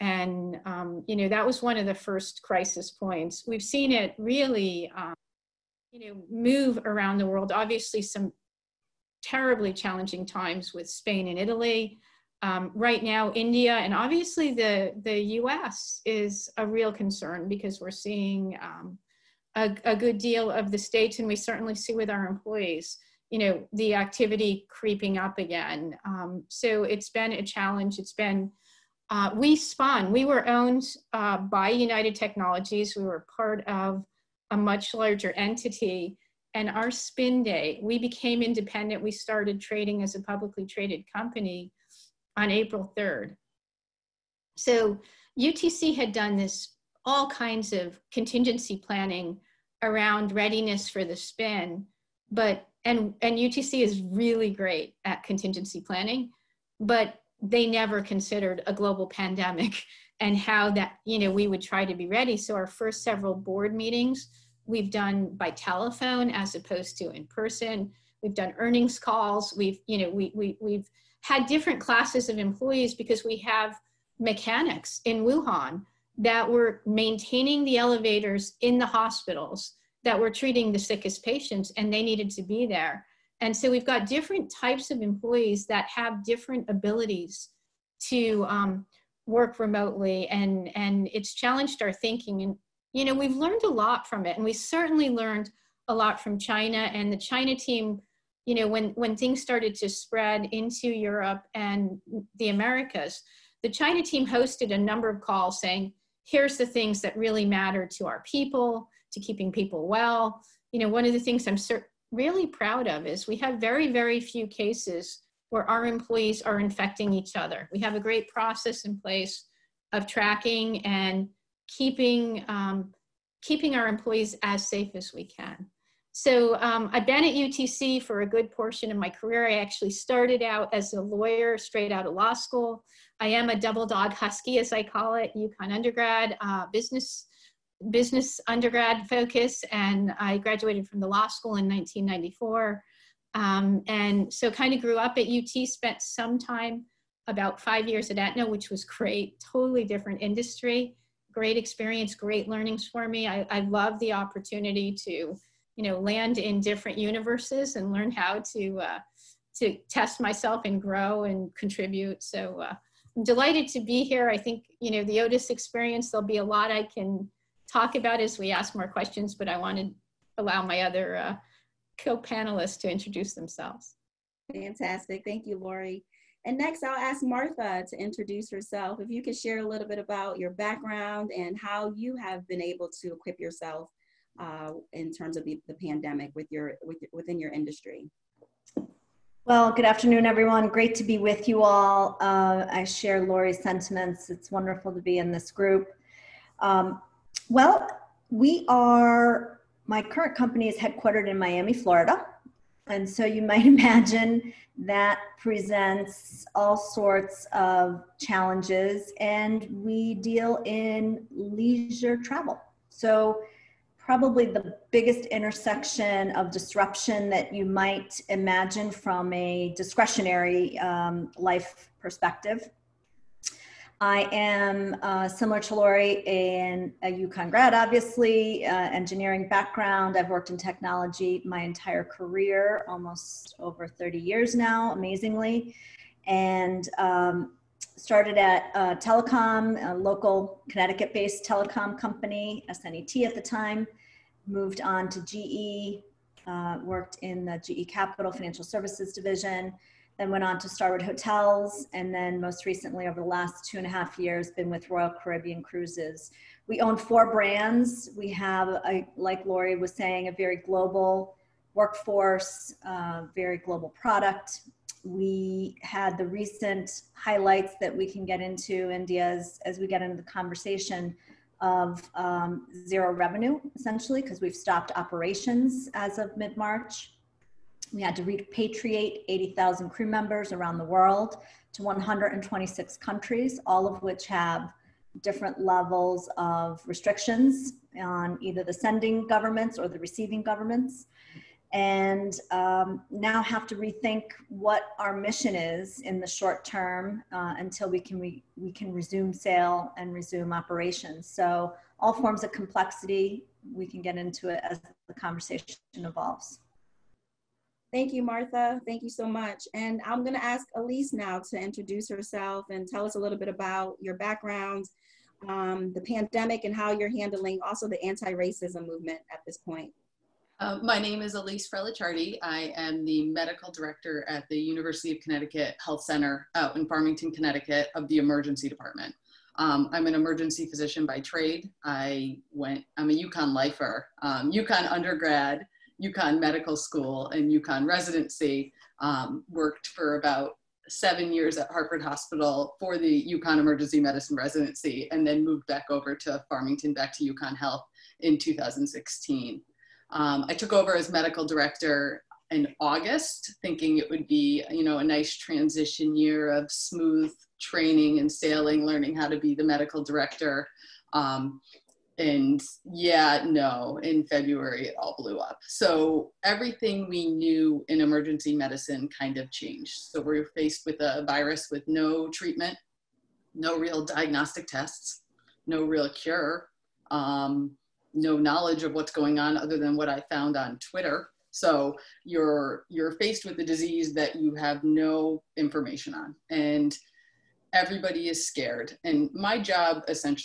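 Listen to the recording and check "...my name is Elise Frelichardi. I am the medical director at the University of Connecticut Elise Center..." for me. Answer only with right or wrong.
wrong.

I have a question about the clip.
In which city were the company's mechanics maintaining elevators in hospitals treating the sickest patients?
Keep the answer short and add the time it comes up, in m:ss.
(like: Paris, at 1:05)
Wuhan, at 1:15.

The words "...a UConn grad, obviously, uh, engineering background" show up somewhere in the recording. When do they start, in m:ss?
3:47.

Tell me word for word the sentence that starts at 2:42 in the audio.
So uh, I'm delighted to be here.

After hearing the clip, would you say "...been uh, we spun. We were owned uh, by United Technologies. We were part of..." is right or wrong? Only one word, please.
right.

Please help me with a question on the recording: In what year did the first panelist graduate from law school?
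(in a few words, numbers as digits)
1994.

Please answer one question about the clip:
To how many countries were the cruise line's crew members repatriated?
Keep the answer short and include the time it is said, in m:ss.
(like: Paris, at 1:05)
126, at 4:41.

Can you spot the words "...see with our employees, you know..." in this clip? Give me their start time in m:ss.
0:21.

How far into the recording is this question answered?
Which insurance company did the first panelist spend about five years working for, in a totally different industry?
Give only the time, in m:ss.
2:28.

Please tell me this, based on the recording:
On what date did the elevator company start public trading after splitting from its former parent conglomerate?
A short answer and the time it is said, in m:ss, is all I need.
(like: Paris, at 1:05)
April 3rd, at 0:42.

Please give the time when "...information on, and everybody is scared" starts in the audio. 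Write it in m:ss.
6:25.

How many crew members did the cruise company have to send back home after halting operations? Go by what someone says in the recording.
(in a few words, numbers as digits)
80,000.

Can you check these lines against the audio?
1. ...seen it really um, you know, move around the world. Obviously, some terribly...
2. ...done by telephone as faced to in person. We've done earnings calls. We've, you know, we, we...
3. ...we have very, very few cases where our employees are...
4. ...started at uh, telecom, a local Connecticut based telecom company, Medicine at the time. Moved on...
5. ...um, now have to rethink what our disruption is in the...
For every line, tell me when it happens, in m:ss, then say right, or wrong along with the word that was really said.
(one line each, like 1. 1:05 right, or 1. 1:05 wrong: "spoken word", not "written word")
1. 0:03 right
2. 1:04 wrong: "opposed", not "faced"
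3. 1:53 right
4. 3:57 wrong: "SNET", not "Medicine"
5. 4:52 wrong: "mission", not "disruption".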